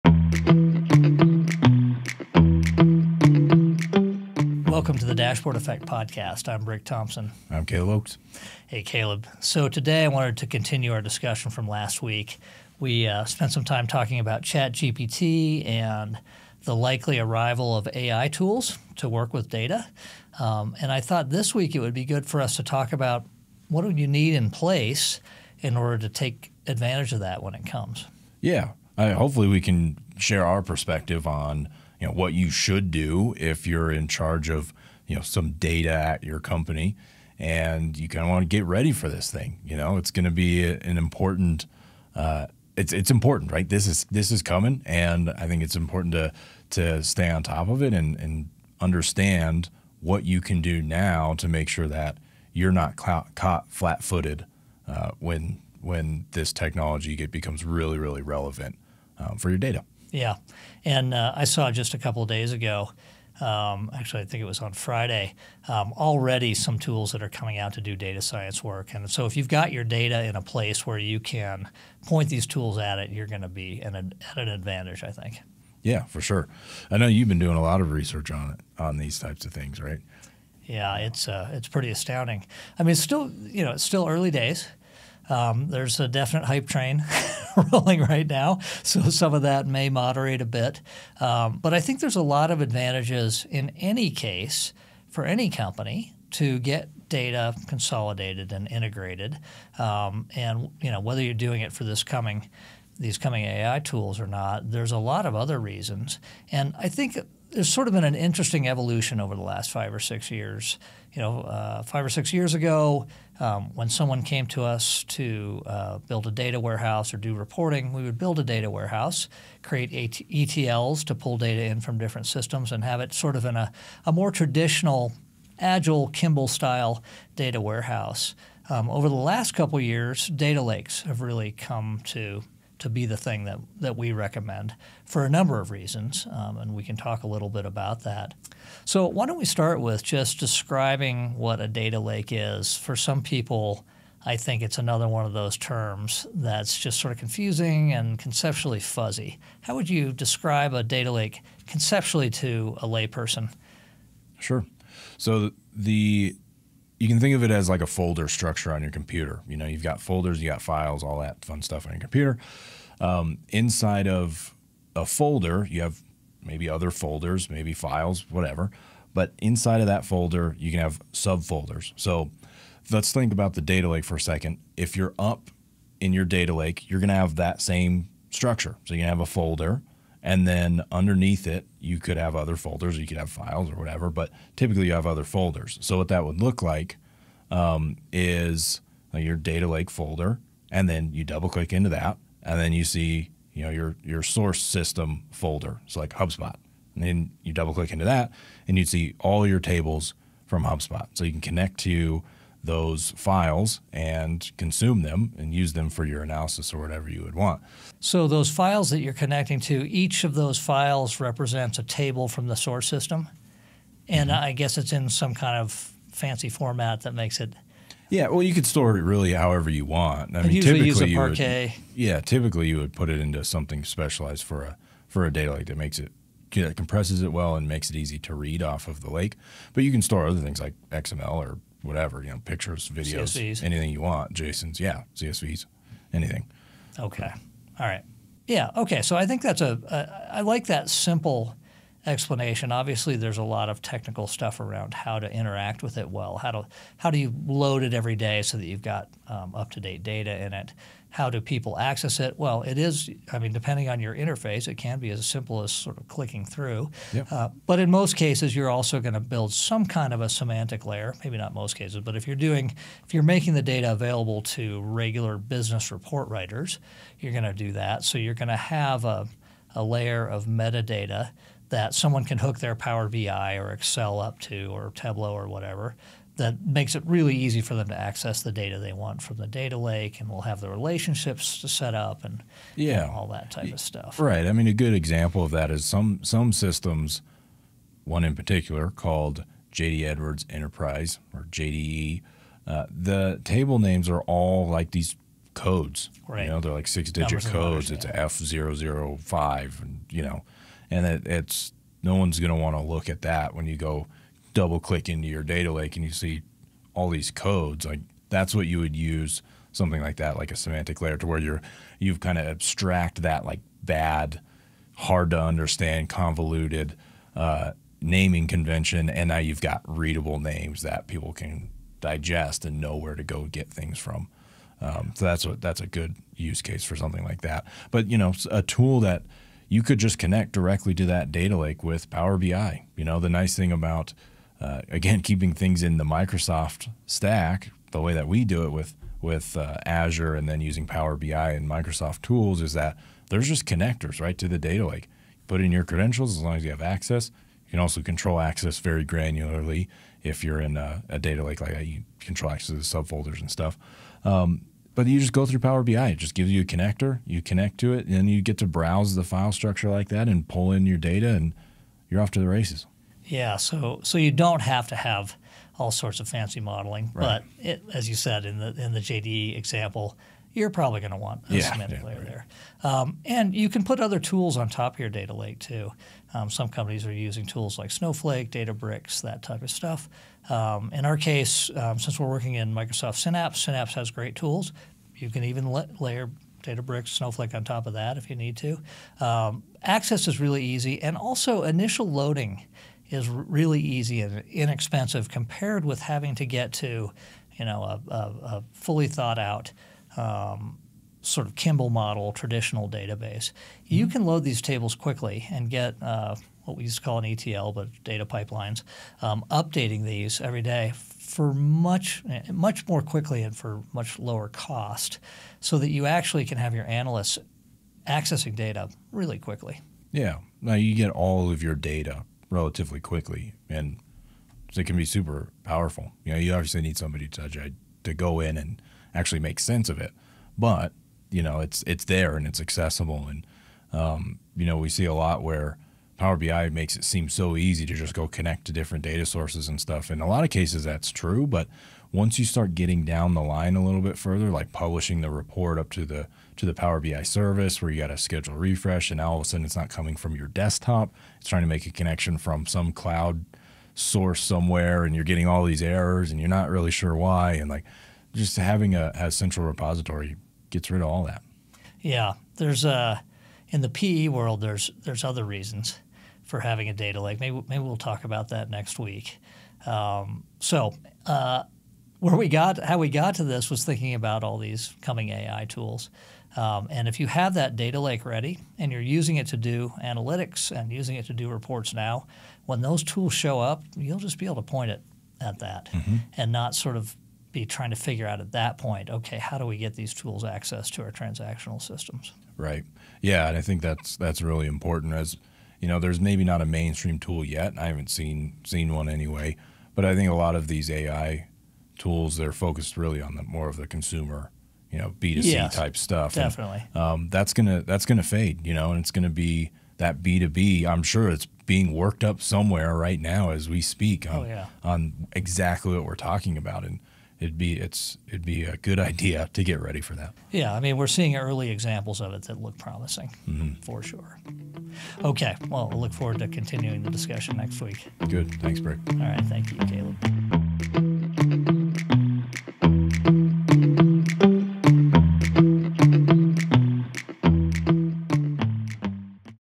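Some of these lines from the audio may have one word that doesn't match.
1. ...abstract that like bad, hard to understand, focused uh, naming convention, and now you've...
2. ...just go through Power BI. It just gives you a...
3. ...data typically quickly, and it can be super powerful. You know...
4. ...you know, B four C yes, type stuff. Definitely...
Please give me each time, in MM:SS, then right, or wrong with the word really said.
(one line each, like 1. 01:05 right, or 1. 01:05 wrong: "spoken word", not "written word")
1. 05:12 wrong: "convoluted", not "focused"
2. 05:55 right
3. 07:01 wrong: "relatively", not "typically"
4. 08:24 wrong: "two", not "four".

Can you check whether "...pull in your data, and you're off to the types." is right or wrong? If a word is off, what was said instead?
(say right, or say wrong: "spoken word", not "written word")
wrong: "races", not "types".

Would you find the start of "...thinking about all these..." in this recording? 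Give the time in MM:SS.
07:53.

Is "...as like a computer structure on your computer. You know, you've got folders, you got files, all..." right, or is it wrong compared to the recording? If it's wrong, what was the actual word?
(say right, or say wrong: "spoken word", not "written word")
wrong: "folder", not "computer".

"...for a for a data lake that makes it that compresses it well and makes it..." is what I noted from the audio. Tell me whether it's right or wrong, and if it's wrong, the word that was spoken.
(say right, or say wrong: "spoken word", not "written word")
right.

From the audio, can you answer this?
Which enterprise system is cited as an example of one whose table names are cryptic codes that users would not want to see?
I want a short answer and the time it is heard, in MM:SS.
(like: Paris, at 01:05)
JD Edwards Enterprise, at 04:49.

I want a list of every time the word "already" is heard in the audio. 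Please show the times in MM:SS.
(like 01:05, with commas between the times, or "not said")
01:05.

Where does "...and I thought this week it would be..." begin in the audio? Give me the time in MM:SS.
00:20.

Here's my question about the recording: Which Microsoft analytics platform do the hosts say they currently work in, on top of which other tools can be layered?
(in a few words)
Microsoft Synapse.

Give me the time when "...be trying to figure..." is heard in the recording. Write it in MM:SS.
08:07.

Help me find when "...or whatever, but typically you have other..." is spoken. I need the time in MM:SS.
03:03.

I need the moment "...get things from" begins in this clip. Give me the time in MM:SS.
05:23.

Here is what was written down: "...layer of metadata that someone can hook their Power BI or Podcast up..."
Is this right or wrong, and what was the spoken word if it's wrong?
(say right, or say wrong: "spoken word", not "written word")
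wrong: "Excel", not "Podcast".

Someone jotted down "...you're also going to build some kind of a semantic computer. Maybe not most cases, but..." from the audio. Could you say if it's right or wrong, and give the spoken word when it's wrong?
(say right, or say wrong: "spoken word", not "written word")
wrong: "layer", not "computer".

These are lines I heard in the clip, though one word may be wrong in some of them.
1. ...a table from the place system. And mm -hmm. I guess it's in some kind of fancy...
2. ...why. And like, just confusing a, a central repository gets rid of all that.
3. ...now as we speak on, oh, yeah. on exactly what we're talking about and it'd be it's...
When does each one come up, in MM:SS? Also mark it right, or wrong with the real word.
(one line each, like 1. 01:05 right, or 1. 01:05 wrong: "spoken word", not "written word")
1. 03:31 wrong: "source", not "place"
2. 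07:37 wrong: "having", not "confusing"
3. 08:33 right.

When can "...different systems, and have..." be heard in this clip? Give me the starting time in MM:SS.
02:01.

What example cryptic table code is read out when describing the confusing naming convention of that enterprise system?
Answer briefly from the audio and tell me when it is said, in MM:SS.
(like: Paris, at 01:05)
F005, at 04:58.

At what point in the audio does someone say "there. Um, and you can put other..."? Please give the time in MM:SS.
06:12.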